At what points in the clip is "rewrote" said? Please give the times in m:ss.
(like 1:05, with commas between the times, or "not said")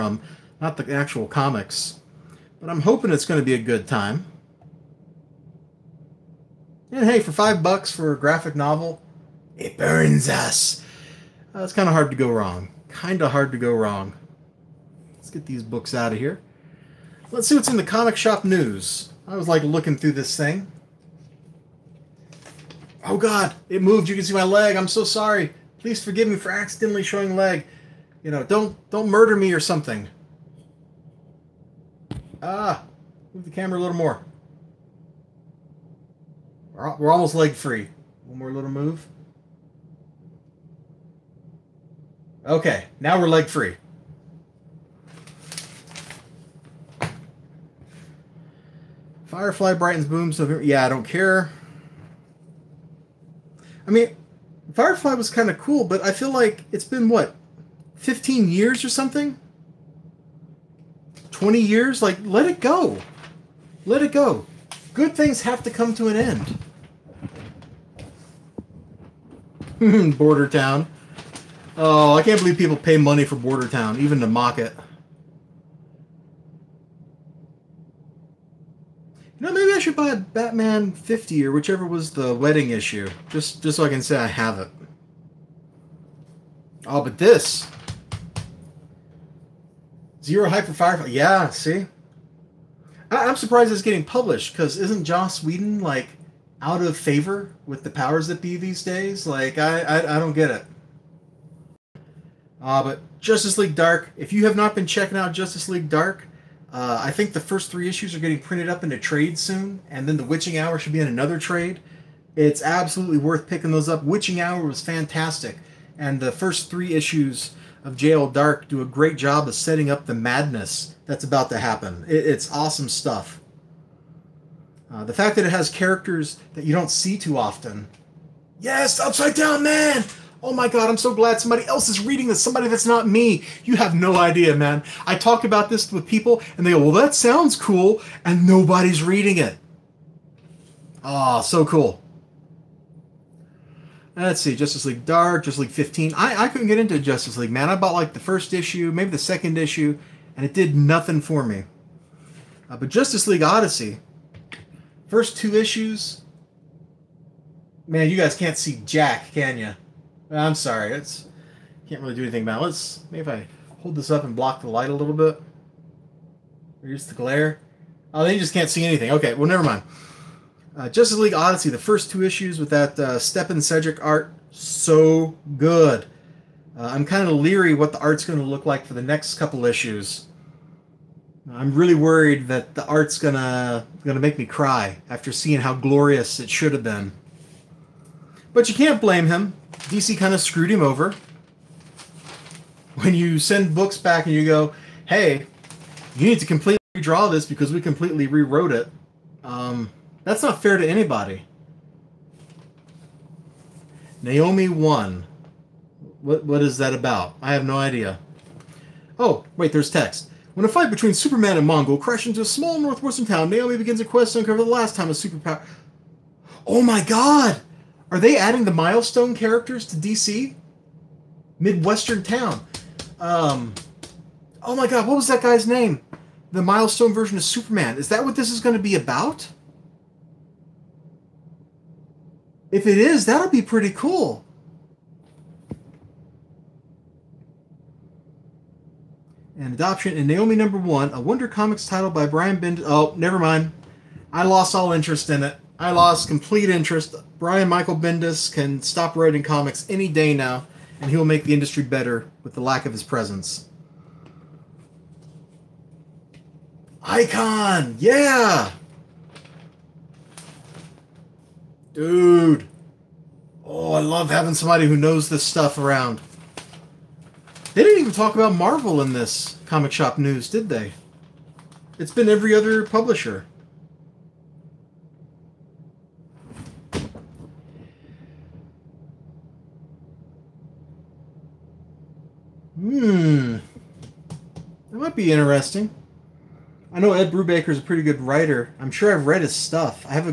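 3:18.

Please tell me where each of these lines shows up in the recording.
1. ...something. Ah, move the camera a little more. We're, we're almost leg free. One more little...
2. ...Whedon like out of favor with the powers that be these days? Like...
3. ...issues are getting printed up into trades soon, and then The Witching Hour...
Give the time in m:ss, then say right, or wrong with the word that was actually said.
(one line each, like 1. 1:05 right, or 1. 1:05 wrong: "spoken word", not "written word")
1. 0:29 right
2. 1:35 right
3. 1:47 right.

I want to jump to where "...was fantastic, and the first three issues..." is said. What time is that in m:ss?
1:54.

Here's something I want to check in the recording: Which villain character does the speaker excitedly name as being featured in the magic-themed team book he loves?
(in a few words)
Upside Down Man.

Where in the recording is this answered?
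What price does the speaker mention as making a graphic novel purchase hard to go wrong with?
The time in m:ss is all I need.
0:07.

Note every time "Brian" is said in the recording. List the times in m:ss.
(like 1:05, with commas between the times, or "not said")
4:02, 4:07.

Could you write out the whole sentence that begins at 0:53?
I mean, Firefly was kind of cool, but I feel like it's been what 15 years or something?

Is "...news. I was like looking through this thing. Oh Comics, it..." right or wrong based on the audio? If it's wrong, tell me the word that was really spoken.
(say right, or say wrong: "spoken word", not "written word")
wrong: "God", not "Comics".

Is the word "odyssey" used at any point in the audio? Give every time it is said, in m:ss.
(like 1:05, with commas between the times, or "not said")
2:33, 2:51.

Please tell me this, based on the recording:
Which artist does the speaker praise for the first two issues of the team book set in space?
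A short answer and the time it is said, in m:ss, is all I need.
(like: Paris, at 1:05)
Stjepan Šejić, at 2:53.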